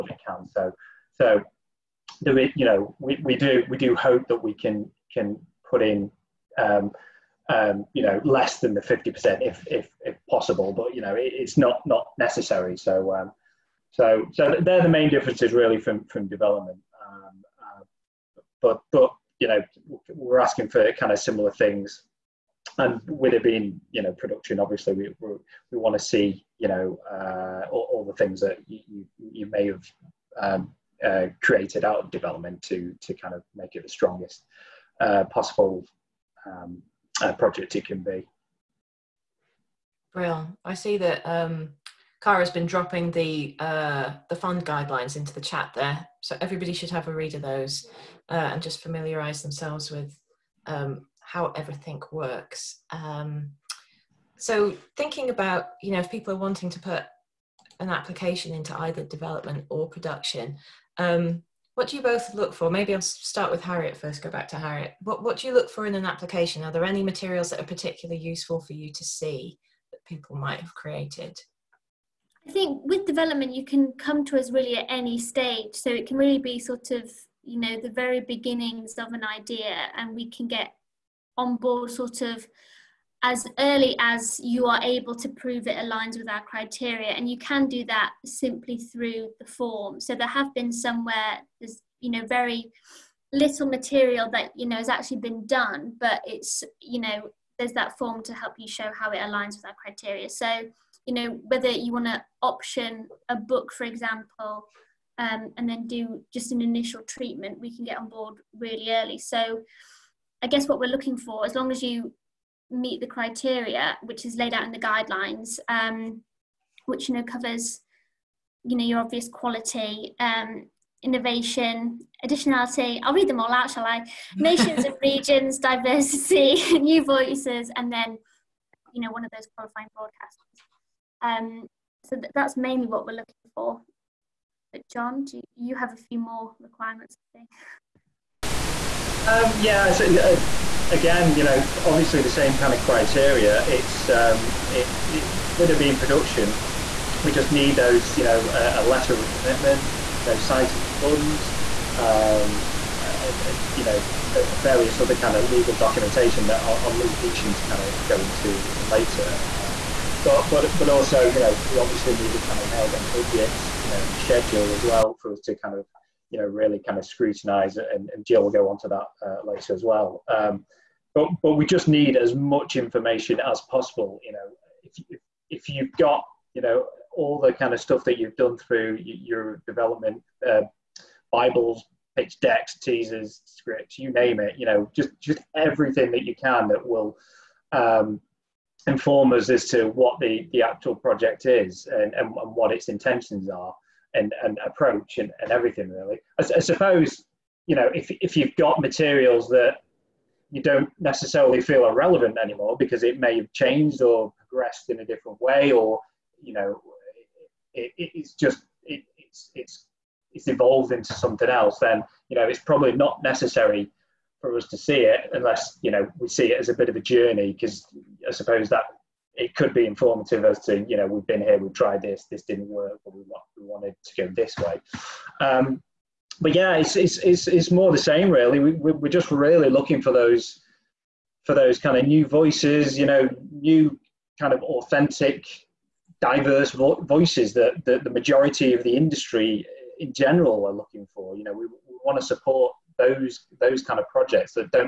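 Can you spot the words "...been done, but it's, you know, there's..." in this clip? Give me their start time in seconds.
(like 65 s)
95 s.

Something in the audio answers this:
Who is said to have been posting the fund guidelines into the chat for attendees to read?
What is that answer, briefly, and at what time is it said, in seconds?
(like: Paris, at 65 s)
Cara, at 42 s.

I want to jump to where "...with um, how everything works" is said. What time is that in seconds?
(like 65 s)
49 s.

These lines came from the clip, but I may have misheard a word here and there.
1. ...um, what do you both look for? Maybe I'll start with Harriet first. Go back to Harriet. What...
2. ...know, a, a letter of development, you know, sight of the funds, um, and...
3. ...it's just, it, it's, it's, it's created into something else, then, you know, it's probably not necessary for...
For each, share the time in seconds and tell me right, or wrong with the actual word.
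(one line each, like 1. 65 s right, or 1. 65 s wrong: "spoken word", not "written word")
1. 60 s right
2. 148 s wrong: "commitment", not "development"
3. 208 s wrong: "evolved", not "created".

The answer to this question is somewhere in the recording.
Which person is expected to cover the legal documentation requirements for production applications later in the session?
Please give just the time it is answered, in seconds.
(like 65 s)
157 s.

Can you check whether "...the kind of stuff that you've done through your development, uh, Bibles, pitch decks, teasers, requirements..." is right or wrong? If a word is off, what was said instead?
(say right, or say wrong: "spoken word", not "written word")
wrong: "scripts", not "requirements".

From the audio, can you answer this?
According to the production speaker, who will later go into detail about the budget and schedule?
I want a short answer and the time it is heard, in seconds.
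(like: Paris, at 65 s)
Jill, at 168 s.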